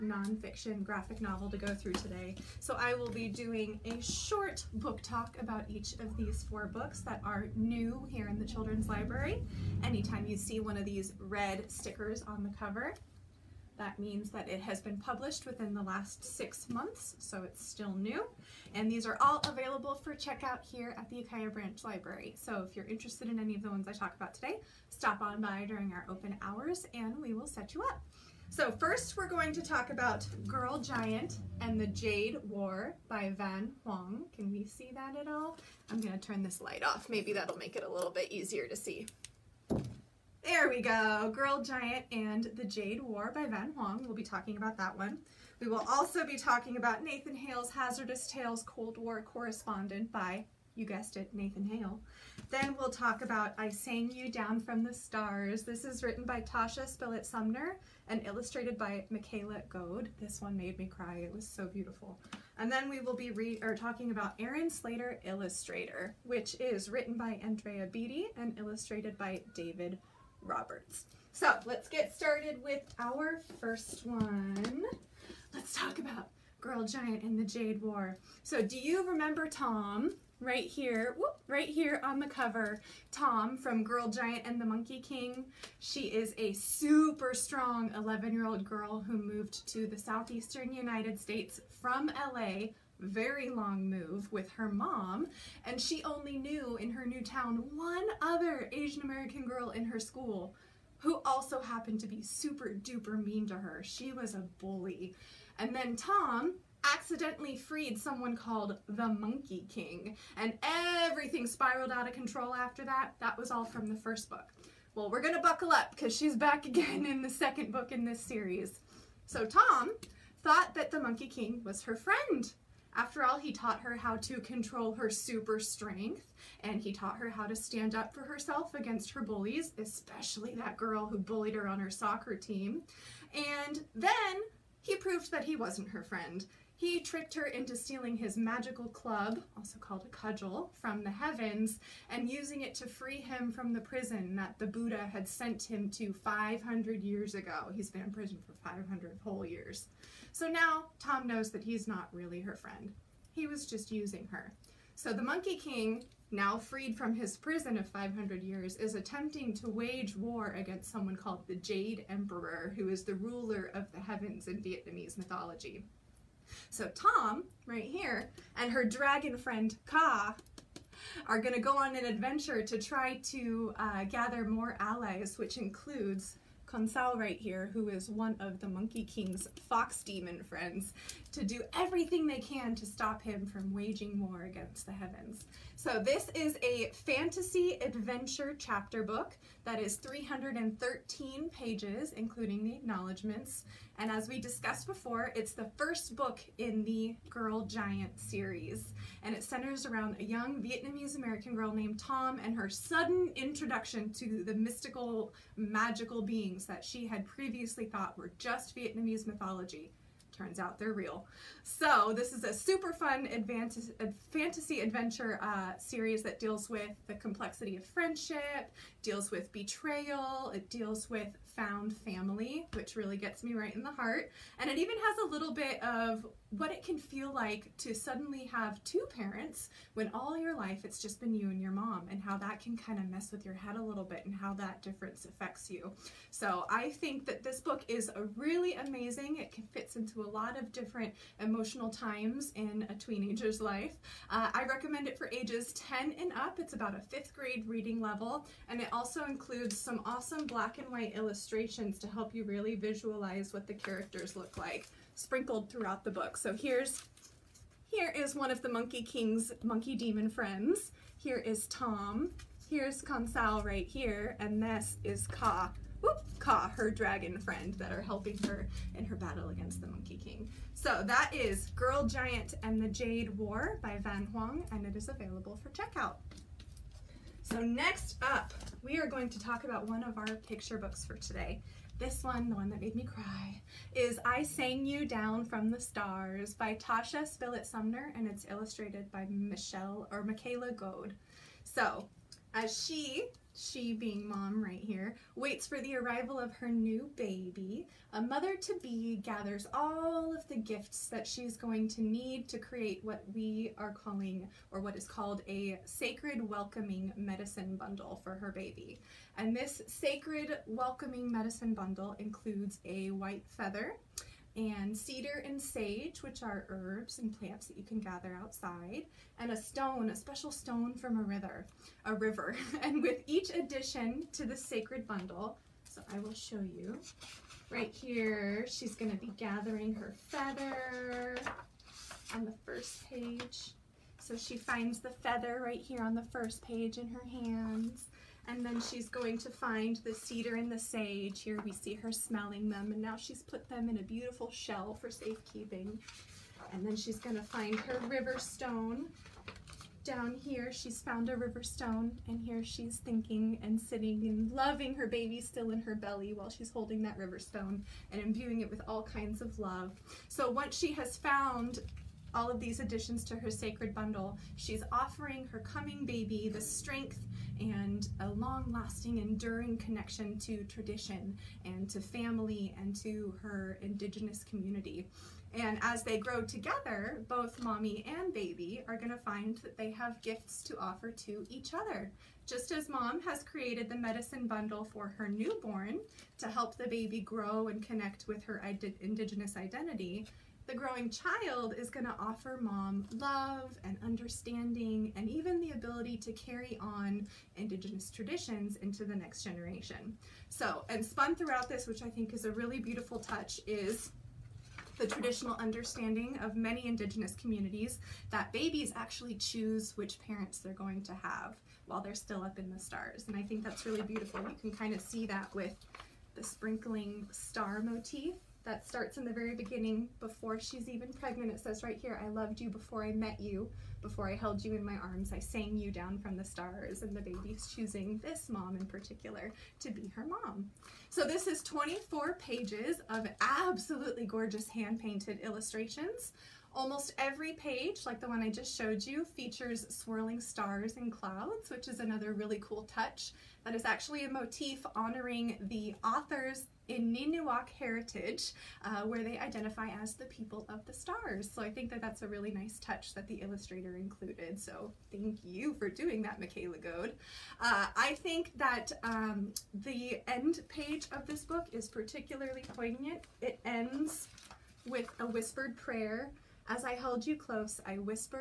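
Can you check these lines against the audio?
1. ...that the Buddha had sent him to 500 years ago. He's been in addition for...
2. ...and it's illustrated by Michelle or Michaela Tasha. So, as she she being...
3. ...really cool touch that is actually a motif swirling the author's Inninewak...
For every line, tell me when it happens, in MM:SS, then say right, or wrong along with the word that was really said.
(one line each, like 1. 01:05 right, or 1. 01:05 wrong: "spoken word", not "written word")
1. 02:24 wrong: "prison", not "addition"
2. 04:48 wrong: "Goade", not "Tasha"
3. 07:22 wrong: "honoring", not "swirling".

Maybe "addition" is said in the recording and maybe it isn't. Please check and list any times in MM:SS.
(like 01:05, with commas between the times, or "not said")
05:23, 06:02.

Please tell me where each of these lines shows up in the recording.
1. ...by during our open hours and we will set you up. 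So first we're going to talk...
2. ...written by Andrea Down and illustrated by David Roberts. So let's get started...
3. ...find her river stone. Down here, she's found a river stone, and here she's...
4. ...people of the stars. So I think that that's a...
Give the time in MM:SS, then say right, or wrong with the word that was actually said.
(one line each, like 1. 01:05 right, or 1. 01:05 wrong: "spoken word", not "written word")
1. 00:25 right
2. 01:06 wrong: "Beaty", not "Down"
3. 05:47 right
4. 07:30 right.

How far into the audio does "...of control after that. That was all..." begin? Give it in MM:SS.
01:52.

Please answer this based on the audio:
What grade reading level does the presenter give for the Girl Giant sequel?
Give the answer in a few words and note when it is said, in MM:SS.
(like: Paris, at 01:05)
Fifth grade, at 04:06.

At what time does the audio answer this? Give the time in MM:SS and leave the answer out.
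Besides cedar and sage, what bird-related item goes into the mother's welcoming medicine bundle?
05:13.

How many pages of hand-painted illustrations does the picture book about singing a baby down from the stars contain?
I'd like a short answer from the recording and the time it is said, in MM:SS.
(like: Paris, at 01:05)
24, at 07:11.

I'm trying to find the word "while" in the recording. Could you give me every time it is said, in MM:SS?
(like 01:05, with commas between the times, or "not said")
05:56, 06:51.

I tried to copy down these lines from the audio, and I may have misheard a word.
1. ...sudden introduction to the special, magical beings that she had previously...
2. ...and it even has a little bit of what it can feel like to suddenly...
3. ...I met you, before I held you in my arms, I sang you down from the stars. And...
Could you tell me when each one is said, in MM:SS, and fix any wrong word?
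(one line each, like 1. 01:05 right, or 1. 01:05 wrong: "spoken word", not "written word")
1. 03:22 wrong: "mystical", not "special"
2. 03:44 right
3. 07:03 right.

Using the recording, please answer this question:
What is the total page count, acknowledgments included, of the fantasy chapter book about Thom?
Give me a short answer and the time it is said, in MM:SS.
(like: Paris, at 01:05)
313, at 03:09.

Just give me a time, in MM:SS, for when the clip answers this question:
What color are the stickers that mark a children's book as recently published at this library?
00:11.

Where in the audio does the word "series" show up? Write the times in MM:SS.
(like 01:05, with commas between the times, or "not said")
01:58, 03:18, 03:35.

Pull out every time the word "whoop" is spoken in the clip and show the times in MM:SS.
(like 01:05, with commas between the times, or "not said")
01:21, 04:26.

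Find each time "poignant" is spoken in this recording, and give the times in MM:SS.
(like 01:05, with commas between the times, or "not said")
07:42.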